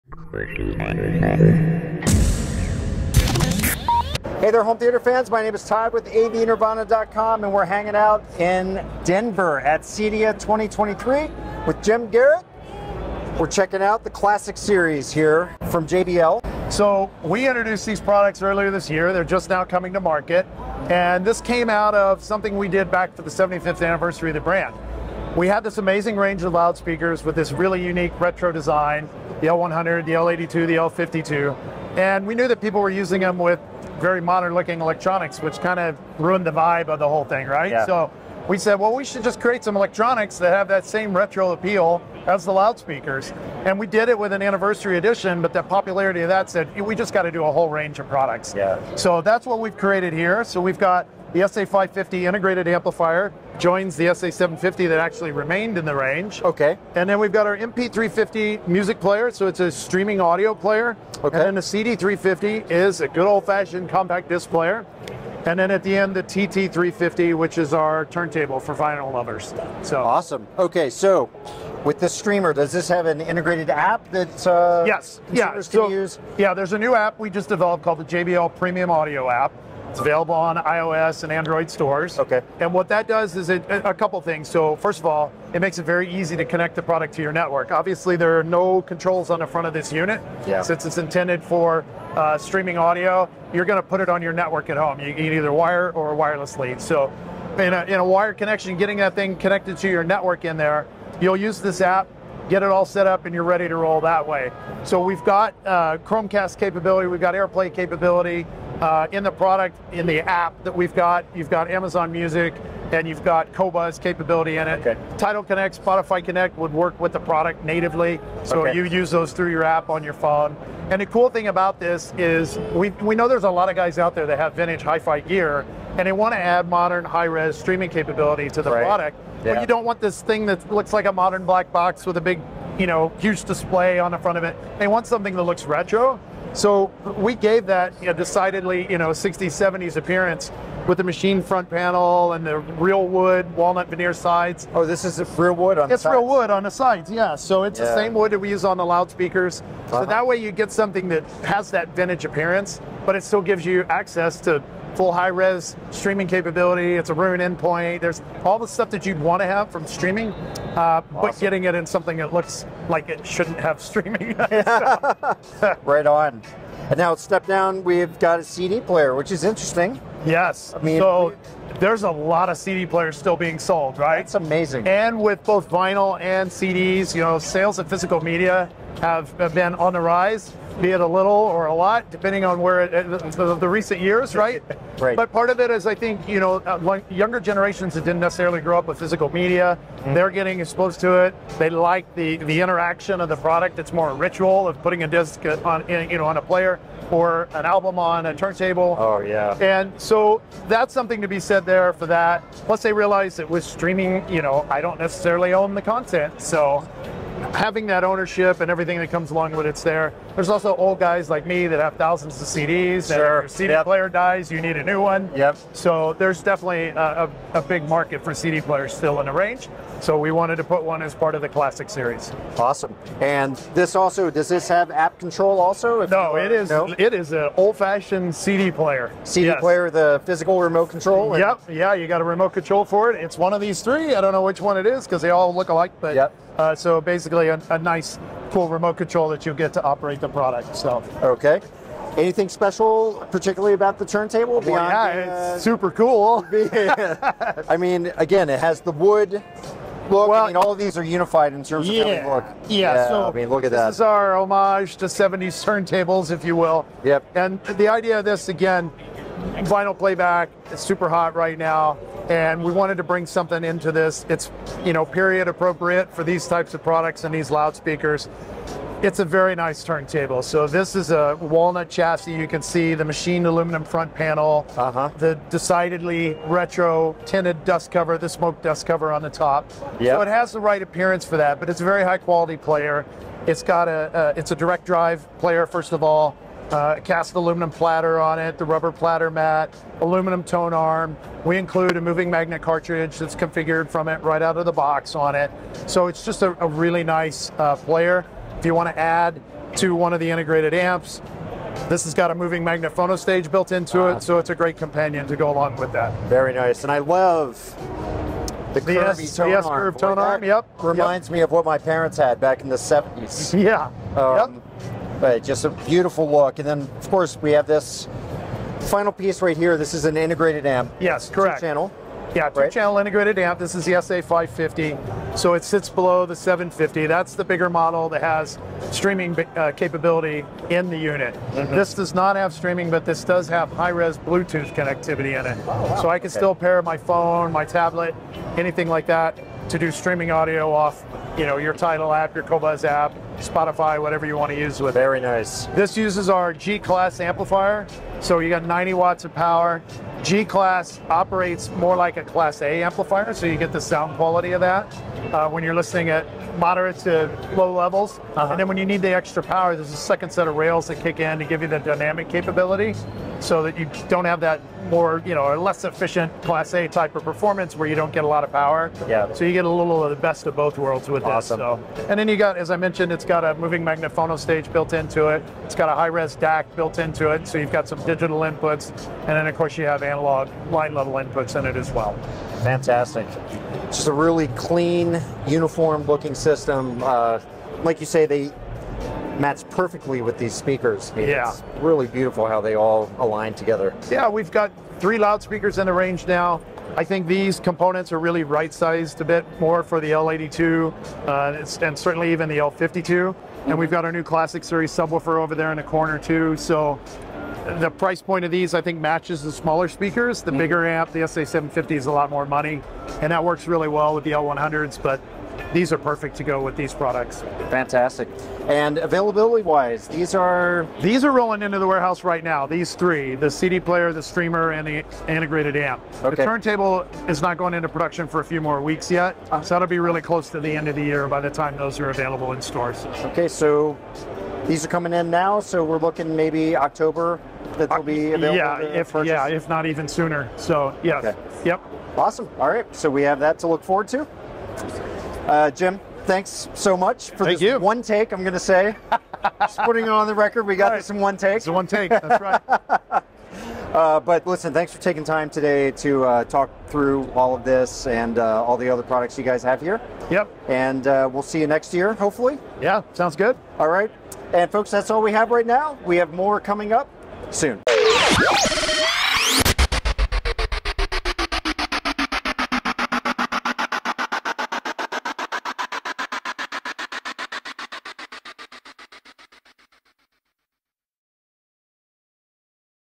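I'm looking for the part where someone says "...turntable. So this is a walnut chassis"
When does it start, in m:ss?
4:29.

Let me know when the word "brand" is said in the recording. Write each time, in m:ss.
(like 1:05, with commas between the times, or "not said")
0:24.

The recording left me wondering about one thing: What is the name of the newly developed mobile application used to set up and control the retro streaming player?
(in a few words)
JBL Premium Audio app.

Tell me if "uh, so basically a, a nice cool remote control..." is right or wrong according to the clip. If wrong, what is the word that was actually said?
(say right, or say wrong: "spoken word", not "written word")
right.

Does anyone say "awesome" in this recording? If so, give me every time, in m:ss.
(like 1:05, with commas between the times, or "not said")
1:10, 2:40, 3:42, 6:11, 7:22.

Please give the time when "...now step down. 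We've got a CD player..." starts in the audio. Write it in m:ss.
2:46.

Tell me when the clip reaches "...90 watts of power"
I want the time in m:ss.
5:48.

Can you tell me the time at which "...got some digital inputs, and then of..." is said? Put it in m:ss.
6:17.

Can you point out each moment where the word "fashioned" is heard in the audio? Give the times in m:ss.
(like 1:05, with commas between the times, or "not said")
1:03, 3:47.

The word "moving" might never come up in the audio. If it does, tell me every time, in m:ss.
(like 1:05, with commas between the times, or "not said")
4:52, 5:02, 6:13.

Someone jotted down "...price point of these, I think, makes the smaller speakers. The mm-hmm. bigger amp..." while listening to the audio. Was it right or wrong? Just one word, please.
wrong.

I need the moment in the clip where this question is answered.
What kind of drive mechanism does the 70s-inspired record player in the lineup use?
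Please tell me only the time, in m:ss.
4:44.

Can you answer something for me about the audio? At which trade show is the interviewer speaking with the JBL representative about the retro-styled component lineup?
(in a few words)
CEDIA 2023.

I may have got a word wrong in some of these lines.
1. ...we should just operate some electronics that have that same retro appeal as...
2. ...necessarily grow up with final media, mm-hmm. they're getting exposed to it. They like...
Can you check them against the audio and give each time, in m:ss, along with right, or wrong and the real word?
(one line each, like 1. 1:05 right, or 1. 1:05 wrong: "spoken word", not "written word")
1. 0:38 wrong: "create", not "operate"
2. 3:08 wrong: "physical", not "final".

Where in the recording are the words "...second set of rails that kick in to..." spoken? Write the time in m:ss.
5:59.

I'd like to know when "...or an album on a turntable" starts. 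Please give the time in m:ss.
3:17.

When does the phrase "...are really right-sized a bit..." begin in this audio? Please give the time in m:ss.
6:38.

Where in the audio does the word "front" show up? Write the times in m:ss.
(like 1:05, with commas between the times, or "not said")
1:29, 2:14, 2:21, 4:33.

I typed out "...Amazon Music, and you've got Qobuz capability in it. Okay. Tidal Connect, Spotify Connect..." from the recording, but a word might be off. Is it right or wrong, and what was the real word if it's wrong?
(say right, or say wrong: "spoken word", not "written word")
right.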